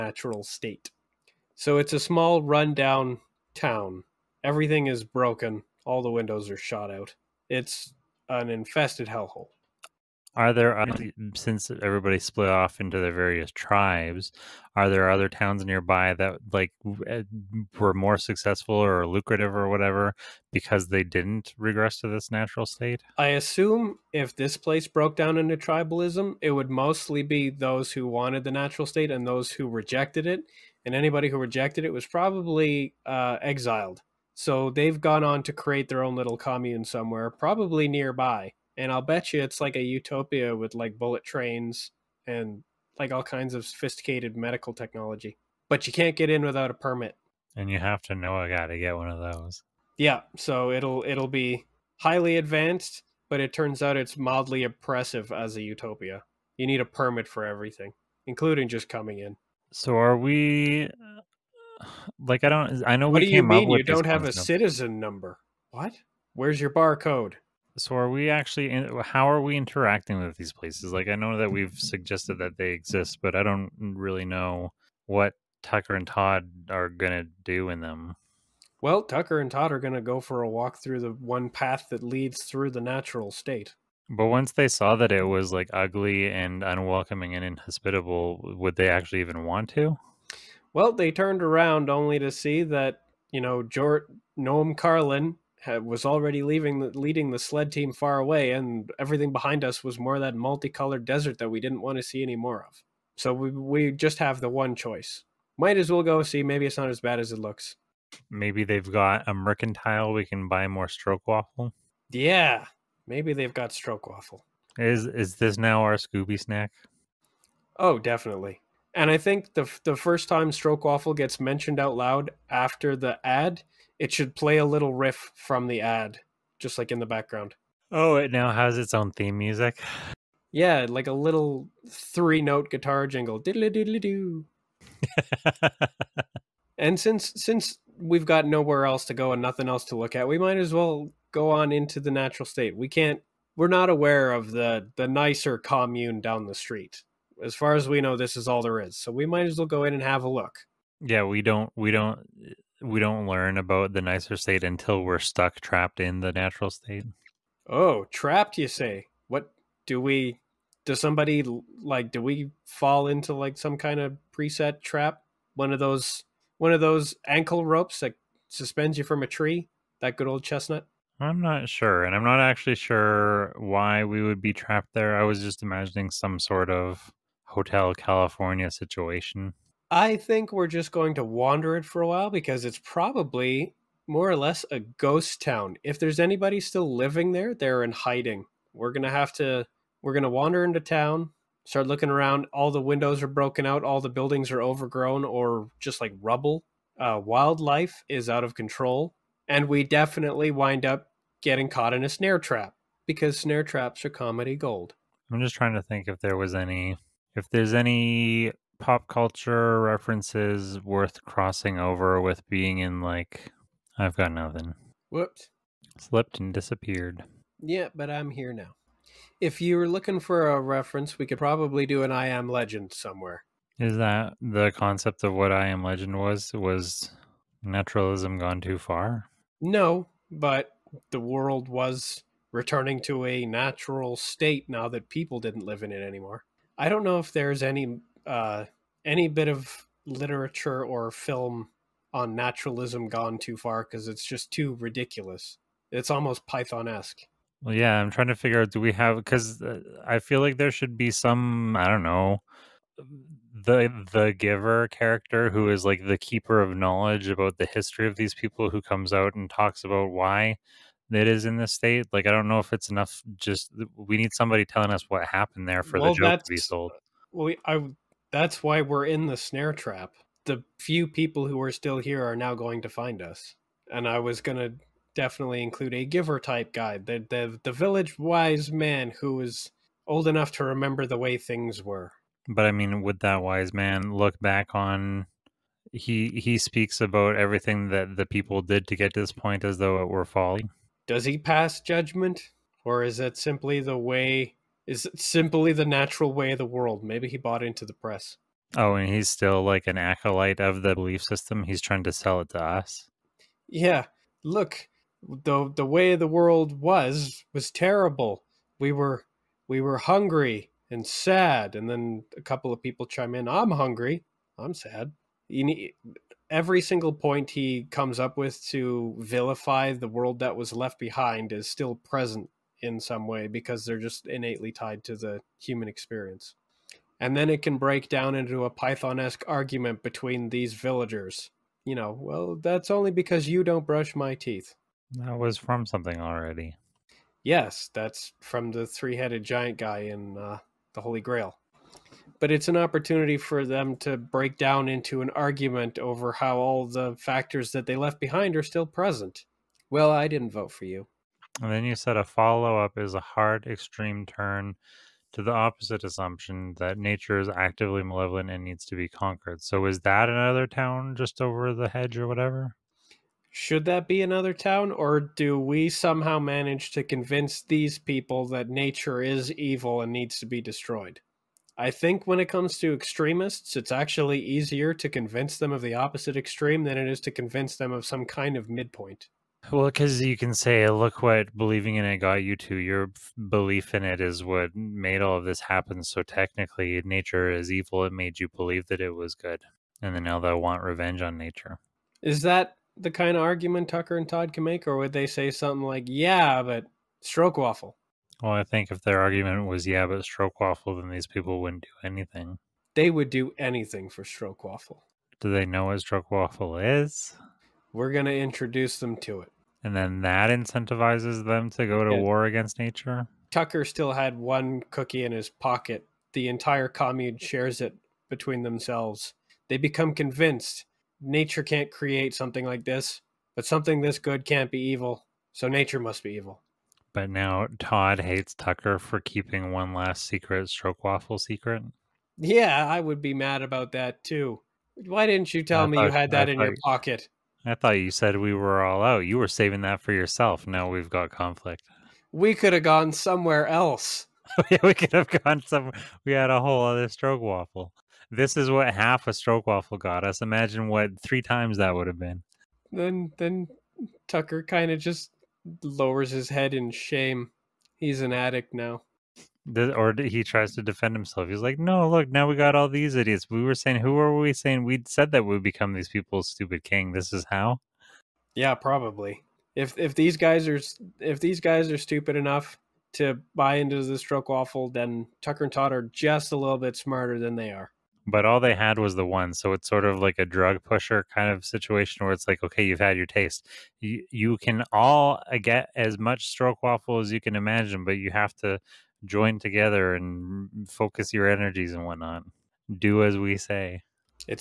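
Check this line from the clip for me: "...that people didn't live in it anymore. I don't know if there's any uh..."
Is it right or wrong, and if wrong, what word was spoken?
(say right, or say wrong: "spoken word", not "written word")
right.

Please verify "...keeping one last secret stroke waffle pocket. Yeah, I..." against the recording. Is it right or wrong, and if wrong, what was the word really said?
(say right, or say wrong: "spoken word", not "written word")
wrong: "secret", not "pocket".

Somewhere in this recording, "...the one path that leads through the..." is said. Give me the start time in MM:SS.
01:20.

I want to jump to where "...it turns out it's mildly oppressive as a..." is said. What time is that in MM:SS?
00:53.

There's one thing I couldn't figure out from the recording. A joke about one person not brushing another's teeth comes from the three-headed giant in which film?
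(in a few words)
The Holy Grail.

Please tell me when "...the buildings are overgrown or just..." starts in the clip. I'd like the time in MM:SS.
03:14.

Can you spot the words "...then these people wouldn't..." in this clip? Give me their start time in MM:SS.
06:41.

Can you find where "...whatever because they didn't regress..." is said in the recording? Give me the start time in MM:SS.
00:19.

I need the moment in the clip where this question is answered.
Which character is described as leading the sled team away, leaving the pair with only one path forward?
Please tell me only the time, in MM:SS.
01:33.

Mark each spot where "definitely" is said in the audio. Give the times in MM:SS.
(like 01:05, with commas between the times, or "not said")
01:57, 03:19, 04:35.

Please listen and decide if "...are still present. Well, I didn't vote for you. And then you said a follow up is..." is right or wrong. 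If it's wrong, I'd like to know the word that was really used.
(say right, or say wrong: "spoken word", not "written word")
right.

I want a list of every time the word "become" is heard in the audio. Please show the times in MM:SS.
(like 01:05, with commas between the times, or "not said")
06:59, 07:45.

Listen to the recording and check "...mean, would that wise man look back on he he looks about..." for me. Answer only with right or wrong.
wrong.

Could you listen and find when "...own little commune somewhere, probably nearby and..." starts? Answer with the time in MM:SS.
00:36.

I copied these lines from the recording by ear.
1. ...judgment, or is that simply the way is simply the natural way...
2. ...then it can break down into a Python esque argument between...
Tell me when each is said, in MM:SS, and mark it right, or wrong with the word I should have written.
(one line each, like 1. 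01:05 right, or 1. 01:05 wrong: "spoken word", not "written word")
1. 04:51 right
2. 05:27 right.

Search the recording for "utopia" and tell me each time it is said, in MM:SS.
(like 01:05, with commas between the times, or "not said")
00:39, 00:55.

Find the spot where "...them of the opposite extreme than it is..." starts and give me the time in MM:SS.
06:15.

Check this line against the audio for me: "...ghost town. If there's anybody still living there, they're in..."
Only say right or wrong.
right.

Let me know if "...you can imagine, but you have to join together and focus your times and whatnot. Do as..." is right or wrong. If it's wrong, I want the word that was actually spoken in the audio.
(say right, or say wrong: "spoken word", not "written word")
wrong: "energies", not "times".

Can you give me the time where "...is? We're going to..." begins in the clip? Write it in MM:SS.
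06:46.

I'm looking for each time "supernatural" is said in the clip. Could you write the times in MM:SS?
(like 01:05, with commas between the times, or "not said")
not said.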